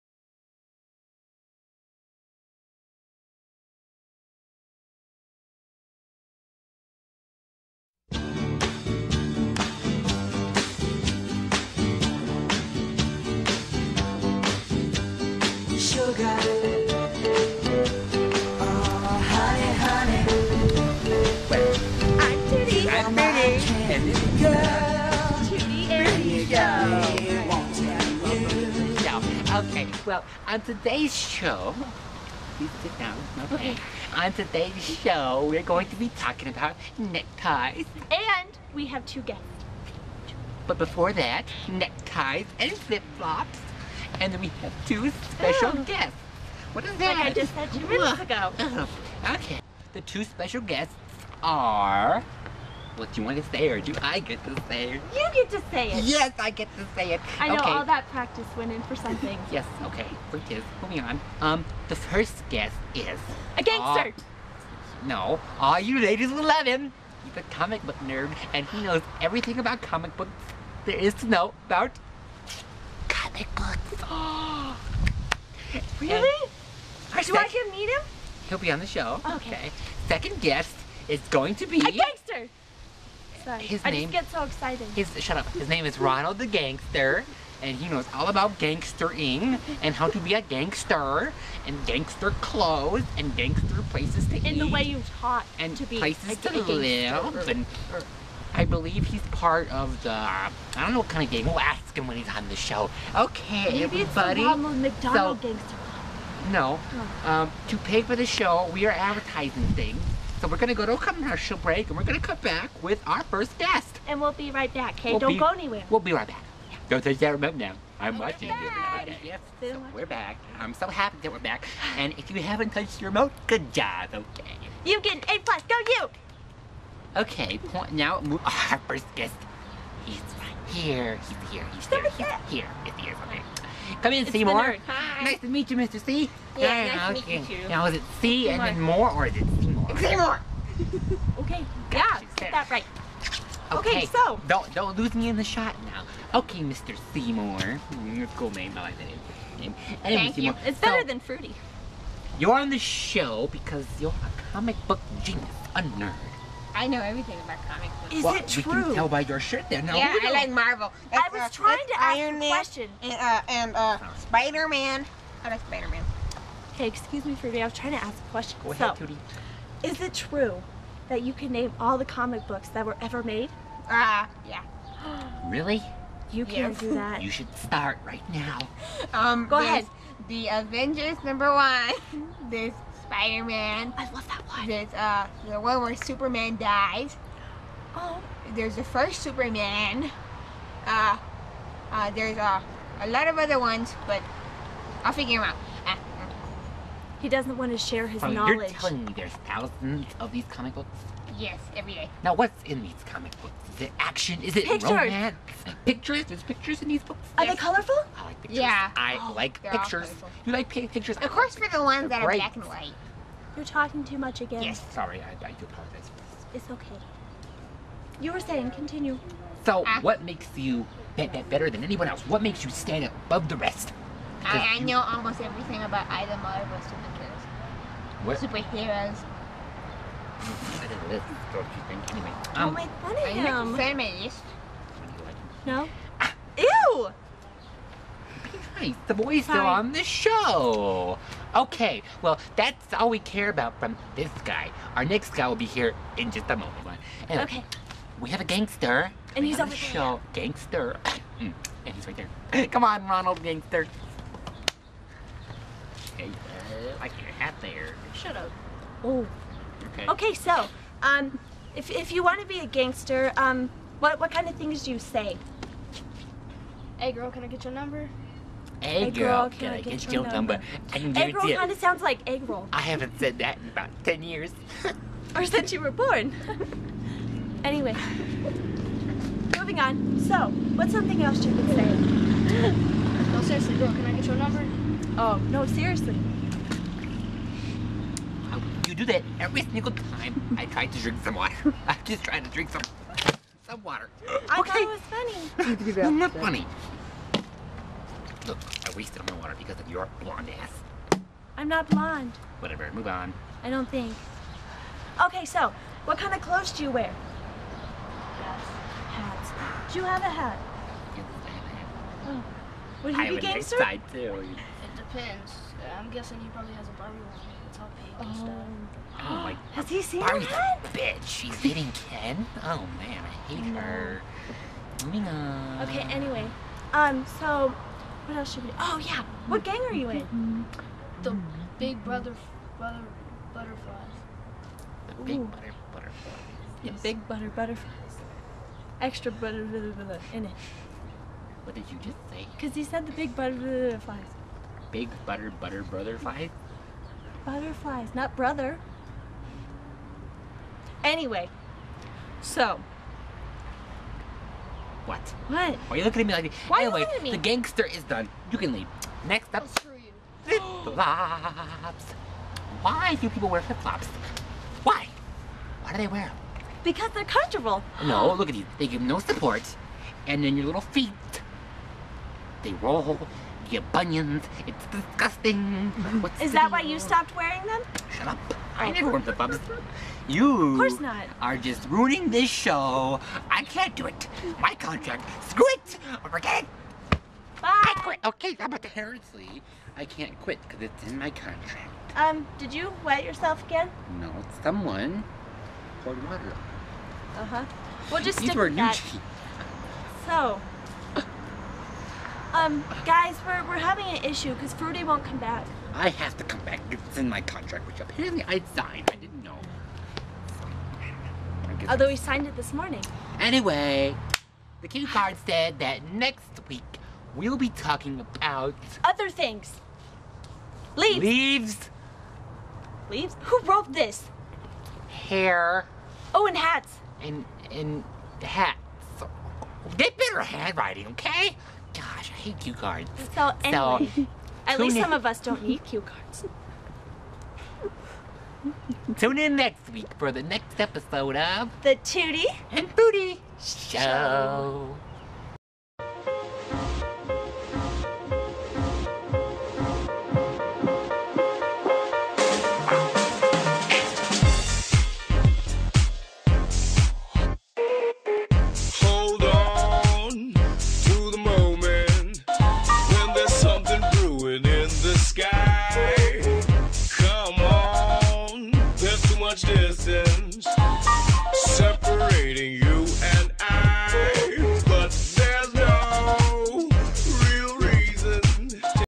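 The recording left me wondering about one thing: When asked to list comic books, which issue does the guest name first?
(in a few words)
The Avengers number one.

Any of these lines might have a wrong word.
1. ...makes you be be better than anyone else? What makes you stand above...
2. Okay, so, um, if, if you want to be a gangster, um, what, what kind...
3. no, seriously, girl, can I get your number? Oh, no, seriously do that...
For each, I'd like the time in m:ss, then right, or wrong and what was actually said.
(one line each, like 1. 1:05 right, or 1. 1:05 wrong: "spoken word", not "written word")
1. 3:40 right
2. 4:20 right
3. 4:43 right.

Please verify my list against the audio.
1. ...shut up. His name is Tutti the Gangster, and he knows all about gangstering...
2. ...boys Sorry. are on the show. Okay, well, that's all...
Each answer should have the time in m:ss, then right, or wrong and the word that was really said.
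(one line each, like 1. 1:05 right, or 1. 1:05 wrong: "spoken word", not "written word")
1. 1:25 wrong: "Ronald", not "Tutti"
2. 3:59 right.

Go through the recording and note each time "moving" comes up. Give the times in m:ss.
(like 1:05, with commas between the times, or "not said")
1:00, 4:39, 5:25.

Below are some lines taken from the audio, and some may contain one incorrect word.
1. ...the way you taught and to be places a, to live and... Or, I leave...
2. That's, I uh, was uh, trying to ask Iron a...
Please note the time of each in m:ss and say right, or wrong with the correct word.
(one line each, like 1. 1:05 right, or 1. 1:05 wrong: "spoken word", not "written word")
1. 1:34 wrong: "believe", not "leave"
2. 2:41 right.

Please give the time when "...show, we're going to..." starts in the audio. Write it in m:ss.
0:34.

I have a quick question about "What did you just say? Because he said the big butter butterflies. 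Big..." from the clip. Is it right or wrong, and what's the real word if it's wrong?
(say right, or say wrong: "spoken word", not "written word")
right.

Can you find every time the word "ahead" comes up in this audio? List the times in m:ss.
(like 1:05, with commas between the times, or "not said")
2:48, 2:59.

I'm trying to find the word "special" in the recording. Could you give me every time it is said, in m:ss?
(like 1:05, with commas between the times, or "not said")
0:45, 0:50.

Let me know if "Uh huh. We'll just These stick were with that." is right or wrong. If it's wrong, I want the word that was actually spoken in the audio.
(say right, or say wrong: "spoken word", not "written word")
right.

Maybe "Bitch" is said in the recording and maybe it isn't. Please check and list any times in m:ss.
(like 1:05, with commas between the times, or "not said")
5:20.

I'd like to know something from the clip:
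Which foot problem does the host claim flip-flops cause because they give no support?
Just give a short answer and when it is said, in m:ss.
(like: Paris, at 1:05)
Bunions, at 6:13.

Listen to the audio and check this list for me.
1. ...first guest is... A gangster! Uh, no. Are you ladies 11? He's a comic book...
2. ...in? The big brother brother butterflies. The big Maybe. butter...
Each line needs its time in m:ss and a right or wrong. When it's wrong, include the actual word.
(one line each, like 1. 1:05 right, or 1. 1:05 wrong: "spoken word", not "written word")
1. 1:01 right
2. 5:30 wrong: "Ooh", not "Maybe".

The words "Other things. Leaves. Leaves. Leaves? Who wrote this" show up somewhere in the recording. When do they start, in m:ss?
6:59.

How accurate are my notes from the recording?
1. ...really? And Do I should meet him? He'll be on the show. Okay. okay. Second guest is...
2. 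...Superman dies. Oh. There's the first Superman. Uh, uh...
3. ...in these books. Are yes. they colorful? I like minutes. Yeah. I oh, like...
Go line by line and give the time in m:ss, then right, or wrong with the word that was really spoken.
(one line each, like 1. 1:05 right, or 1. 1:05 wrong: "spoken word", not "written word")
1. 1:16 right
2. 3:05 right
3. 3:26 wrong: "pictures", not "minutes".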